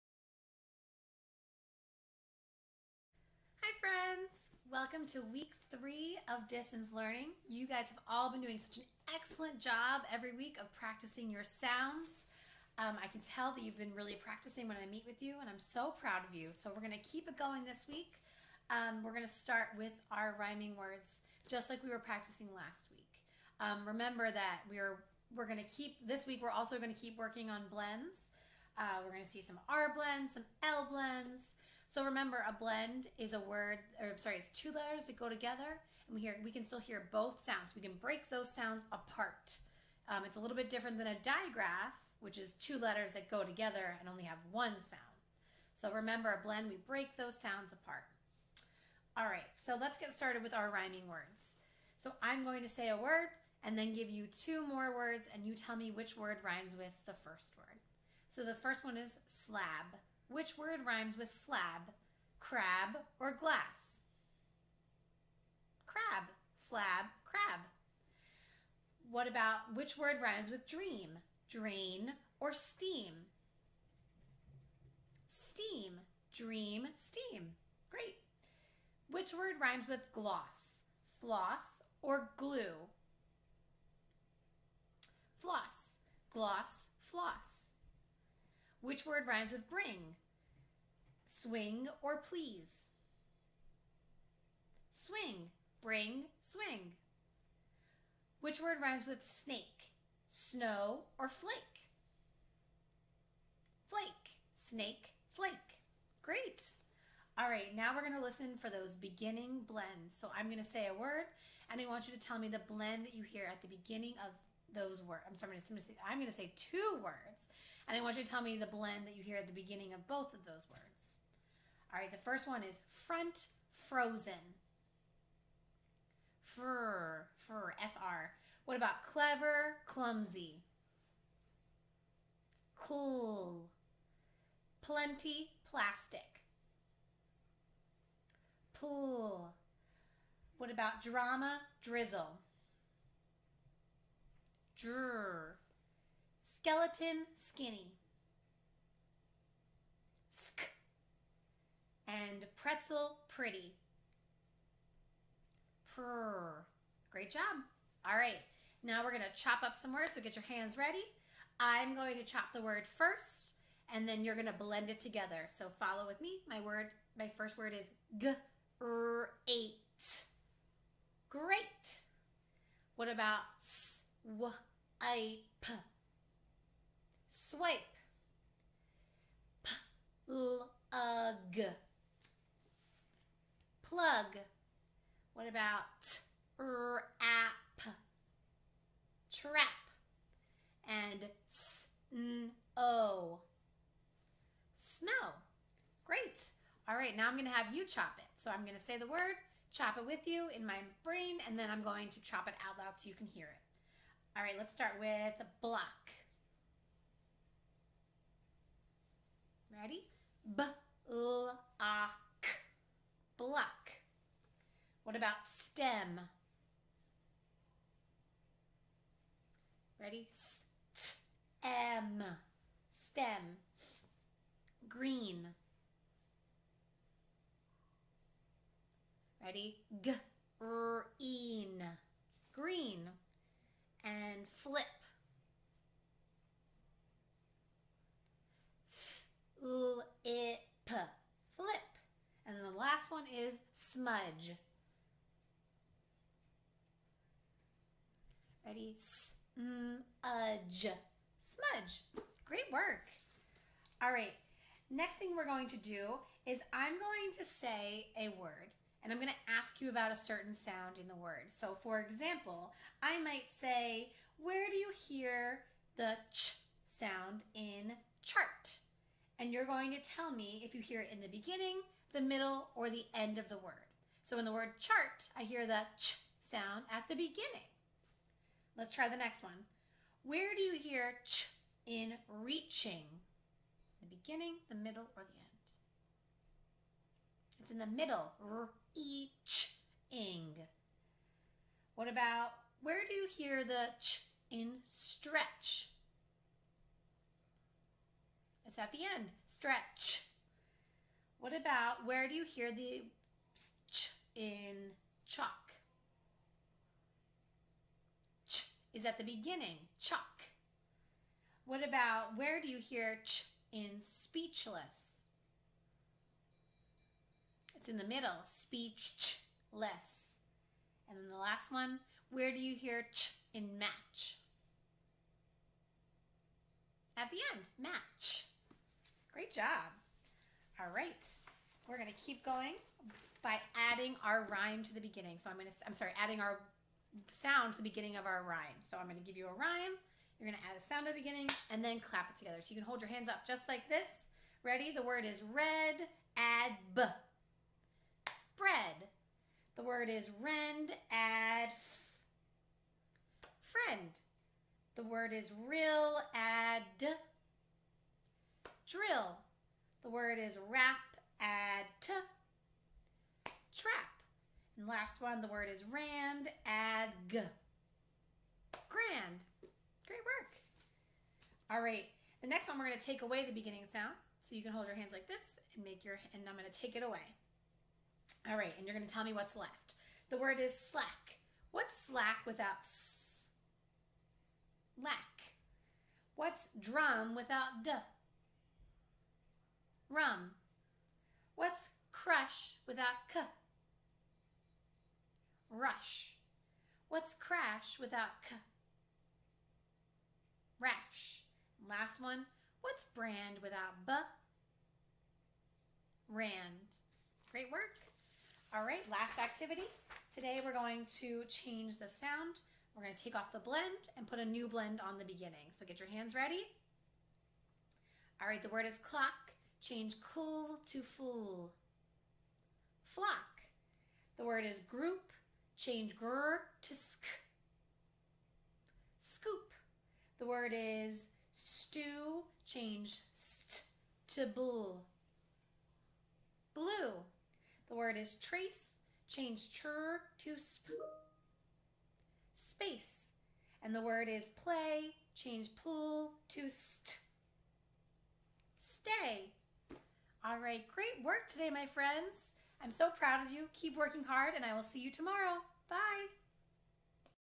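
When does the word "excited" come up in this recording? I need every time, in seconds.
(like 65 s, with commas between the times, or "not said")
not said.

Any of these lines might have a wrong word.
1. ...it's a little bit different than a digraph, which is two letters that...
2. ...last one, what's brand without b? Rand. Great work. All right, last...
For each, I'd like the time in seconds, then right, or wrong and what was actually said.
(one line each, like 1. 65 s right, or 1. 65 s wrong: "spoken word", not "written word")
1. 40 s right
2. 401 s right.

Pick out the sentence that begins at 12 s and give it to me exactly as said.
Um, I can tell that you've been really practicing when I meet with you, and I'm so proud of you.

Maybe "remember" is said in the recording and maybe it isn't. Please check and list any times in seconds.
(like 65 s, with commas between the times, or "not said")
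23 s, 32 s, 45 s.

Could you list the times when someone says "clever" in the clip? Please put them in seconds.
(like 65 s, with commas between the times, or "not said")
129 s.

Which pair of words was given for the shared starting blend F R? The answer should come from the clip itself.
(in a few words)
front, frozen.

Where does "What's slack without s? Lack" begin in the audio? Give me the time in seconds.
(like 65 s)
381 s.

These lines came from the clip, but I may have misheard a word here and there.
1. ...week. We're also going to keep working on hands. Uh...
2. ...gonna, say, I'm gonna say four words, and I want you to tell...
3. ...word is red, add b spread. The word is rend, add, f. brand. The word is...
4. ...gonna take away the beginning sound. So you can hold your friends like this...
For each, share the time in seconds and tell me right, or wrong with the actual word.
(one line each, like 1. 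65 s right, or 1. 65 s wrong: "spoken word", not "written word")
1. 26 s wrong: "blends", not "hands"
2. 115 s wrong: "two", not "four"
3. 345 s wrong: "friend", not "brand"
4. 372 s wrong: "hands", not "friends".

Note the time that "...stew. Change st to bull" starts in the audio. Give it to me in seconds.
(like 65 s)
431 s.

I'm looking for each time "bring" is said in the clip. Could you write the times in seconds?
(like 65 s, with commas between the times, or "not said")
89 s, 95 s.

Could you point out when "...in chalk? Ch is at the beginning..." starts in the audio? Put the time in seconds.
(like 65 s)
304 s.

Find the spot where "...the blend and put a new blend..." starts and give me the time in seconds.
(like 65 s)
413 s.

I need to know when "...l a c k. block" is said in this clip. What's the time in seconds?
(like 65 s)
211 s.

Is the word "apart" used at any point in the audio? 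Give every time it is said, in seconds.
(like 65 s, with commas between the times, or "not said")
38 s, 47 s.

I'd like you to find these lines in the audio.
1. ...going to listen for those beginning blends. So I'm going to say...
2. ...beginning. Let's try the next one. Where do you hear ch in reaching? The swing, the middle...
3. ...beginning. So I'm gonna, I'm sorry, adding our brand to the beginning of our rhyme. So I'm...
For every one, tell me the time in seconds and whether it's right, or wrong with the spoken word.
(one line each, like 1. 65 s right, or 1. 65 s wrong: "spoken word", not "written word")
1. 108 s right
2. 277 s wrong: "beginning", not "swing"
3. 335 s wrong: "sound", not "brand".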